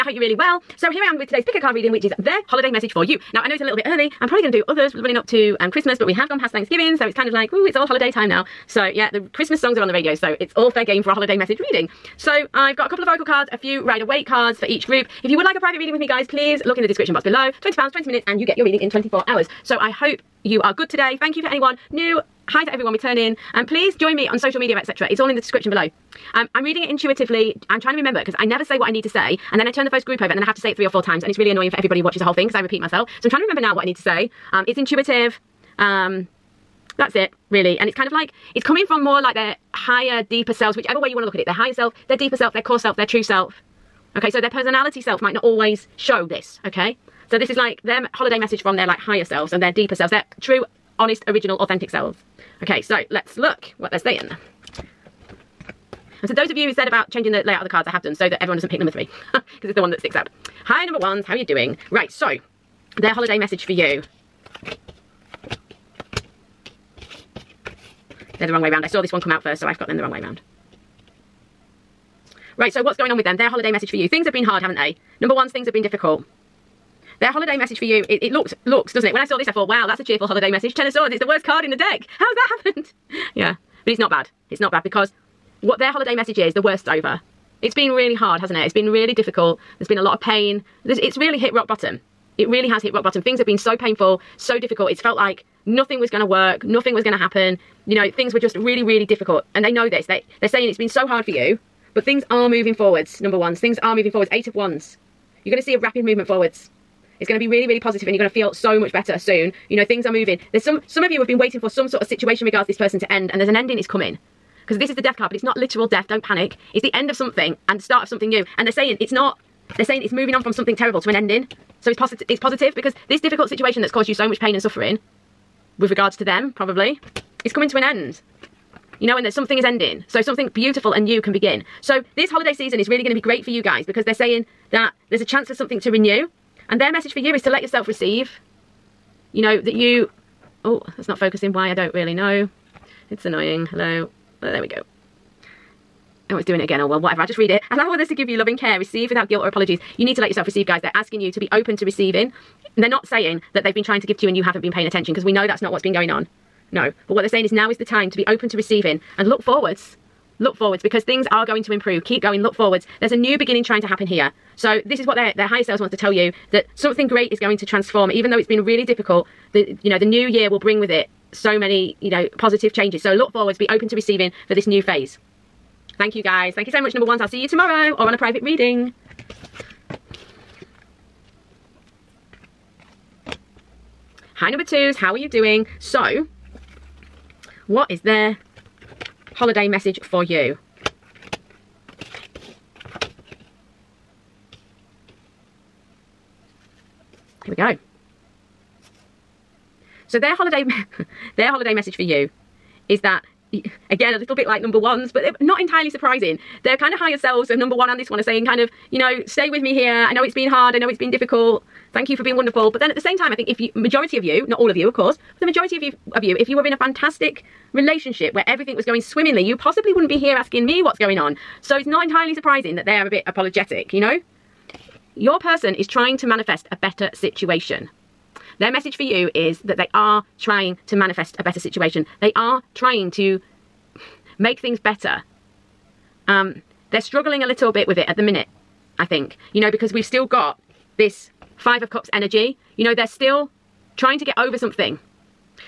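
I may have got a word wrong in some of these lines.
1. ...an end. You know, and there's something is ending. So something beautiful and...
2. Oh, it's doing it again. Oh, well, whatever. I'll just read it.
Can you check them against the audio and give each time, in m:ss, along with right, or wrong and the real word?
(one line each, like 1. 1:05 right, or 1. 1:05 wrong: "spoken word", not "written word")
1. 2:07 right
2. 2:26 right.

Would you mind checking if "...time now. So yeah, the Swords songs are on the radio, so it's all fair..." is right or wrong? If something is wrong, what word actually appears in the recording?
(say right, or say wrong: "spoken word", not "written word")
wrong: "Christmas", not "Swords".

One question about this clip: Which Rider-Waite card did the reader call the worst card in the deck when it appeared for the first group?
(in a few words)
Ten of Swords.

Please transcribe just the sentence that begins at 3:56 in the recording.
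Um, they're struggling a little bit with it at the minute, I think.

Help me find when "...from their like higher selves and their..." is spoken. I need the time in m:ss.
0:48.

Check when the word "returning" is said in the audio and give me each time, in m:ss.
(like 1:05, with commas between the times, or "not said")
0:22.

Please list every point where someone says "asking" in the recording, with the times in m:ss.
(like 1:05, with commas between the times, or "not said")
2:30, 3:40.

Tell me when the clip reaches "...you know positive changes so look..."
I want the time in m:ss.
2:52.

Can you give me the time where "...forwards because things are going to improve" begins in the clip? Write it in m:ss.
2:40.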